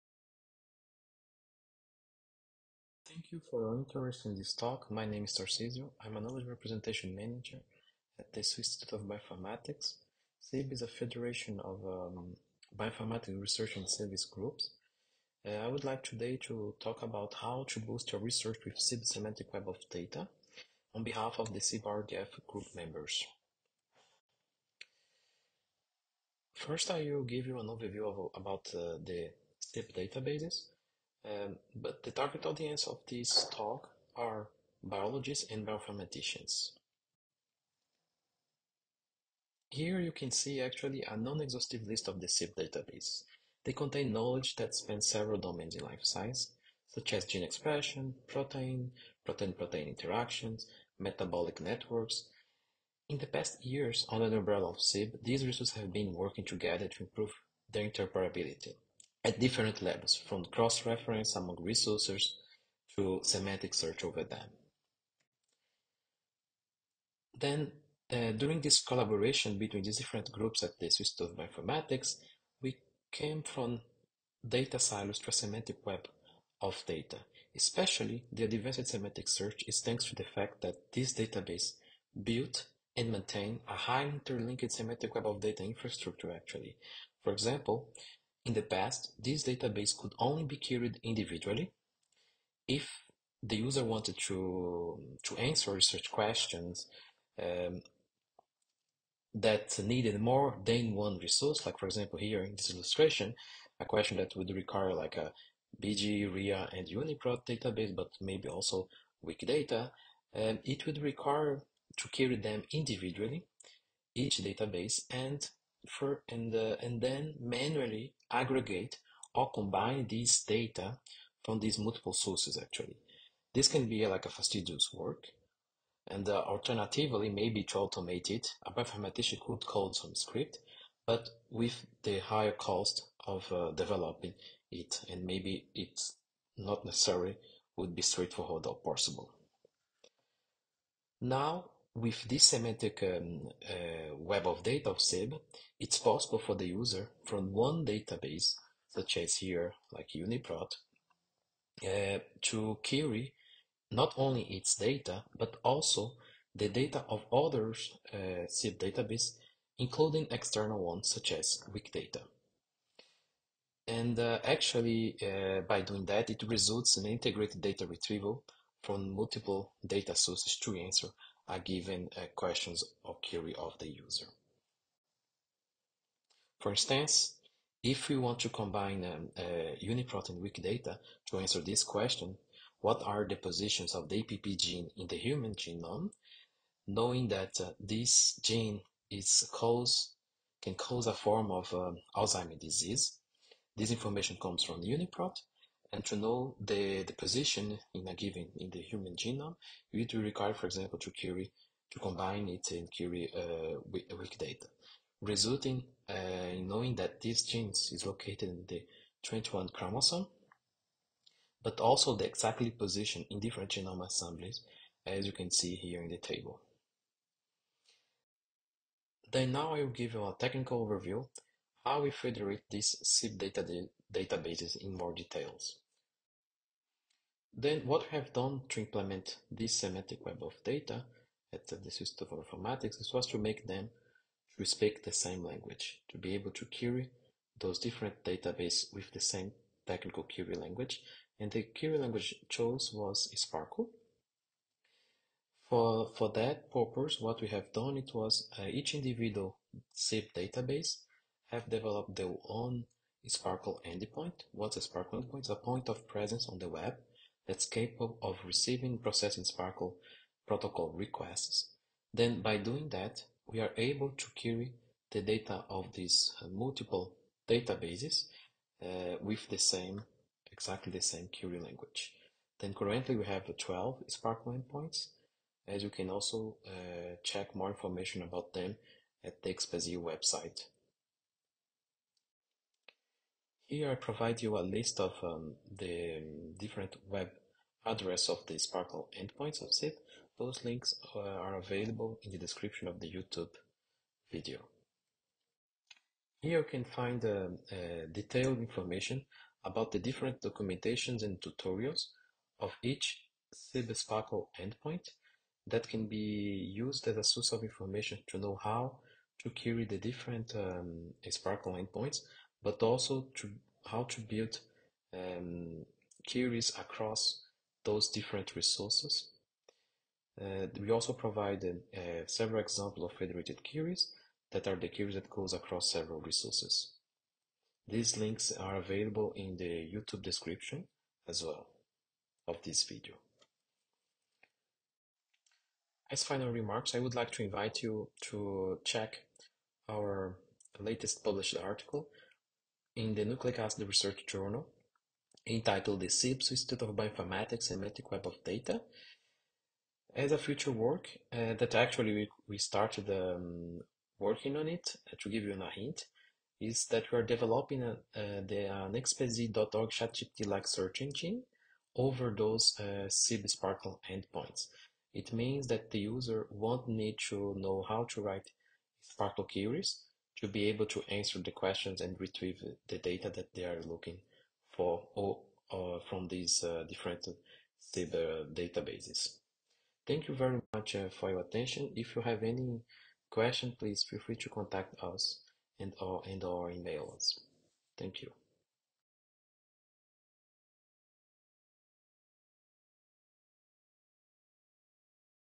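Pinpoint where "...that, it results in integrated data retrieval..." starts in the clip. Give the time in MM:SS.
02:46.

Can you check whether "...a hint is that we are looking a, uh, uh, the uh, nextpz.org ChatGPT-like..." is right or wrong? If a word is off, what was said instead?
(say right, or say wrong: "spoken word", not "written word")
wrong: "developing", not "looking".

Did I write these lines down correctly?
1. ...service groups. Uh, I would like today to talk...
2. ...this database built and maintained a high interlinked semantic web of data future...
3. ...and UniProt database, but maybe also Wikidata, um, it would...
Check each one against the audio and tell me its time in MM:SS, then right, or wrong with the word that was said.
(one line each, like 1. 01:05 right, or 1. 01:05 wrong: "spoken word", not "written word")
1. 00:13 right
2. 01:20 wrong: "infrastructure", not "future"
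3. 01:46 right.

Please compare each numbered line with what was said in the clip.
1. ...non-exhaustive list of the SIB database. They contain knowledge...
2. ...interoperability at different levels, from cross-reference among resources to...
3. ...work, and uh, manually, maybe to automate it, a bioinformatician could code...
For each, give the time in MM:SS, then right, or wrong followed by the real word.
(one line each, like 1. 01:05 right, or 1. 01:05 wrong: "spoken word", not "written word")
1. 00:41 right
2. 00:57 right
3. 02:04 wrong: "alternatively", not "manually".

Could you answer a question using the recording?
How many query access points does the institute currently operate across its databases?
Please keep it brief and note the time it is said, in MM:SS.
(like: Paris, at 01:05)
12, at 04:33.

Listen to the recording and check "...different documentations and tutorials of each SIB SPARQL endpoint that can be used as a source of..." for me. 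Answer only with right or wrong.
right.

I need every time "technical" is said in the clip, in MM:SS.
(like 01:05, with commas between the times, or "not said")
03:40, 03:59.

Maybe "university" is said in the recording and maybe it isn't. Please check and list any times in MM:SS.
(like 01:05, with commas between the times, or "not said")
not said.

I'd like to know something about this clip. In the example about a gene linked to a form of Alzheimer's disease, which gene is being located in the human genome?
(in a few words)
APP.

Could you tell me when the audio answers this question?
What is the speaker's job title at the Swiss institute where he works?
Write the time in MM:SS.
00:06.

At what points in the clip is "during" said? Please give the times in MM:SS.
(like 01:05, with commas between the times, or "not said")
01:08.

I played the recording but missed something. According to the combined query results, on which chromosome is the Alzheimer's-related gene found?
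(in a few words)
21.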